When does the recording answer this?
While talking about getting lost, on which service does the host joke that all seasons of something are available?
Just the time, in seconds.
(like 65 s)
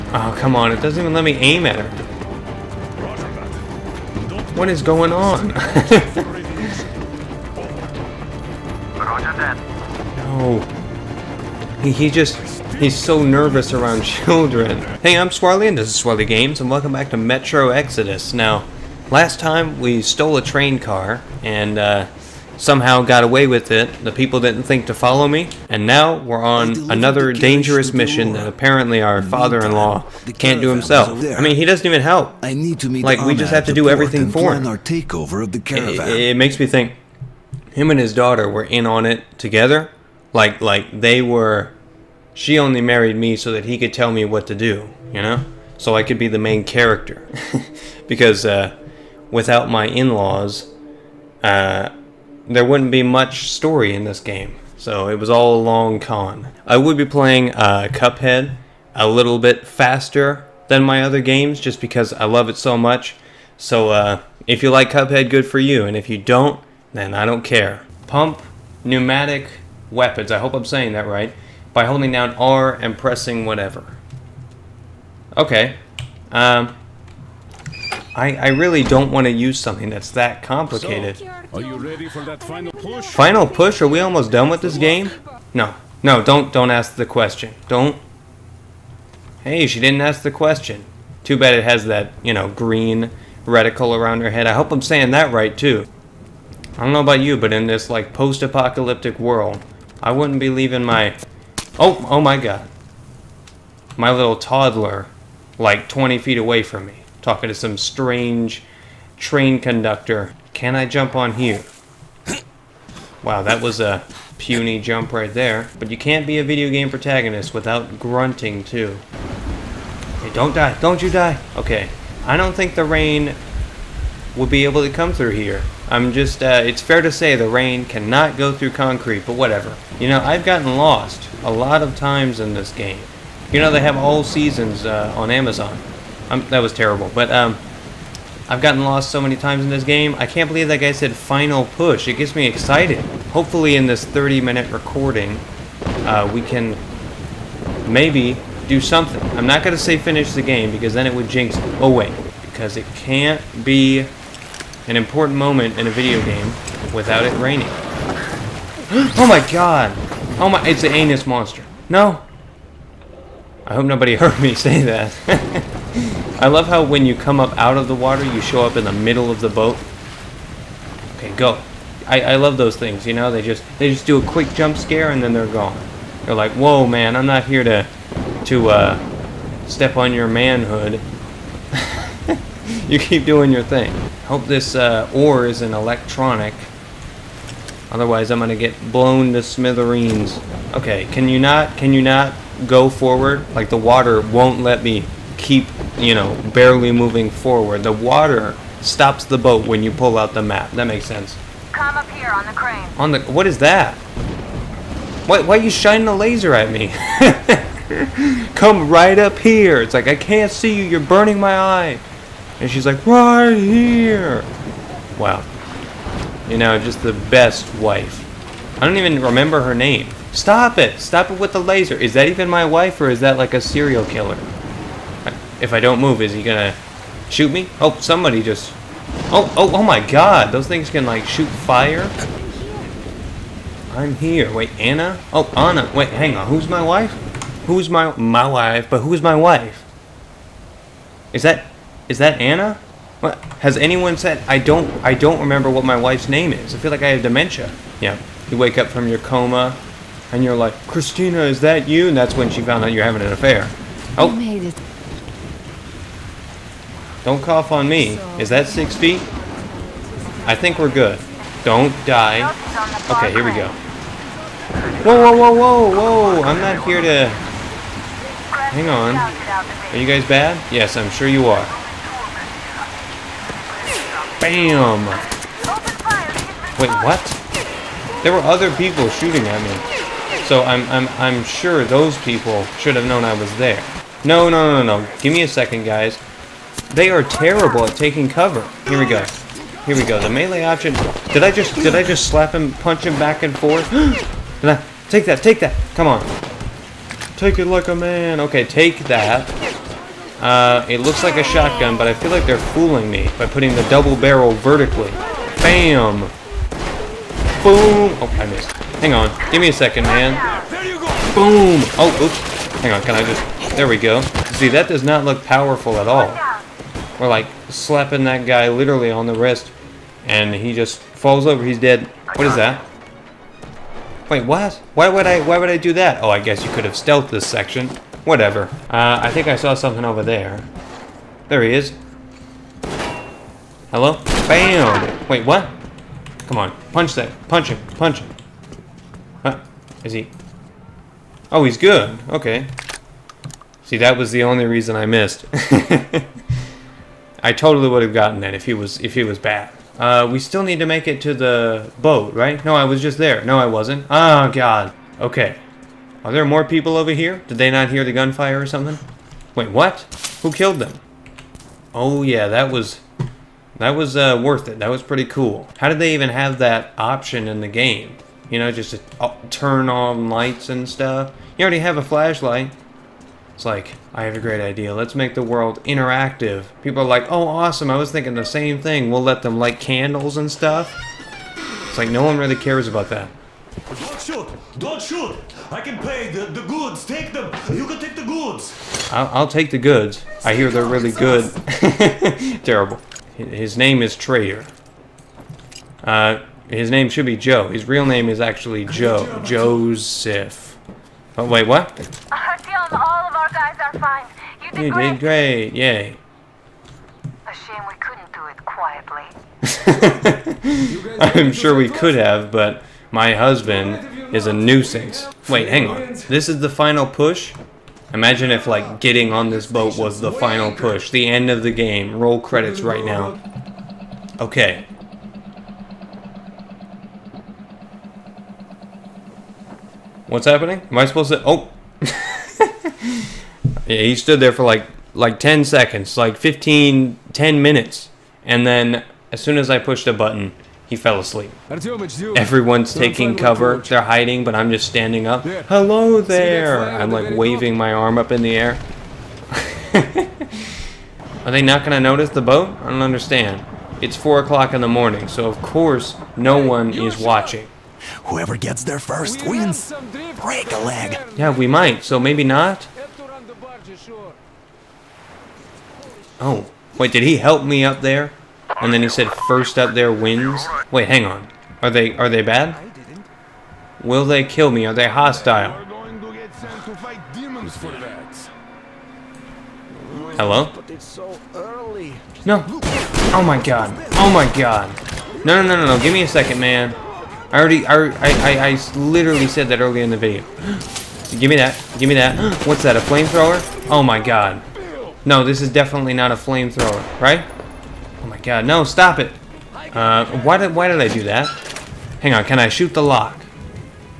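135 s.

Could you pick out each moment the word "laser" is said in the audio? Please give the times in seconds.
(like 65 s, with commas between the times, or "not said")
206 s, 221 s.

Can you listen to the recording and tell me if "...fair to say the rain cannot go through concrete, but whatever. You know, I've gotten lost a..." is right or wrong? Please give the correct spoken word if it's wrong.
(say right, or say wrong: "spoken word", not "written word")
right.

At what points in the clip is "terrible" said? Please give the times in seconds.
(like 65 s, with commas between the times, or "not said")
136 s, 287 s, 392 s.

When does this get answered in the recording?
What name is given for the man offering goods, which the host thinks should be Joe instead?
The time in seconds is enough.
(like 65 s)
394 s.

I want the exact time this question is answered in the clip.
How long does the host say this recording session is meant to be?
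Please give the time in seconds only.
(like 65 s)
144 s.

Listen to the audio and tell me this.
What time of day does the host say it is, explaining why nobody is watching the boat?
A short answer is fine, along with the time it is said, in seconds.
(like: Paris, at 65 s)
4 o'clock in the morning, at 454 s.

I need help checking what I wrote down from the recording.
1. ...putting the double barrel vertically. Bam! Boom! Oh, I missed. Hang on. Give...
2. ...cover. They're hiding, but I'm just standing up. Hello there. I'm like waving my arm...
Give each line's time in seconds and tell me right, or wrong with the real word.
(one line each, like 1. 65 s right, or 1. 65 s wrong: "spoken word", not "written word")
1. 303 s right
2. 443 s right.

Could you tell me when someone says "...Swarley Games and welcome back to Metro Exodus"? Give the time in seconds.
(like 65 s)
16 s.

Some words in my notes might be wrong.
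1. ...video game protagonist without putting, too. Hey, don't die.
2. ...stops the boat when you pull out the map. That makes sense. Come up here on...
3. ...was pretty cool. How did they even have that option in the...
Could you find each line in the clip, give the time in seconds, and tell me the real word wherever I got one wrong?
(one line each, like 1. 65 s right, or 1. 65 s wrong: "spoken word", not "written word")
1. 116 s wrong: "grunting", not "putting"
2. 198 s right
3. 364 s right.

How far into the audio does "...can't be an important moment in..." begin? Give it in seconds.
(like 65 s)
152 s.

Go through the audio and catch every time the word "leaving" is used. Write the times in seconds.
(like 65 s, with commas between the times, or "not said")
100 s.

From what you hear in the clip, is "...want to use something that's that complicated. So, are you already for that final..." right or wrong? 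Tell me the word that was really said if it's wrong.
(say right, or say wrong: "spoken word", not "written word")
wrong: "ready", not "already".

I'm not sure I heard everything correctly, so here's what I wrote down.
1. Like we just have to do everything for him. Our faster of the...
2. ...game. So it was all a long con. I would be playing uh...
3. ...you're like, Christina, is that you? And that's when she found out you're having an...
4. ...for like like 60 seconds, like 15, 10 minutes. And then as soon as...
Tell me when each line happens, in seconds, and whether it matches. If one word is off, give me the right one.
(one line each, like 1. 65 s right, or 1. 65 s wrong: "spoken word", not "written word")
1. 33 s wrong: "takeover", not "faster"
2. 54 s right
3. 250 s right
4. 434 s wrong: "10", not "60".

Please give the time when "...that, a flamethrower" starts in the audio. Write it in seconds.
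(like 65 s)
492 s.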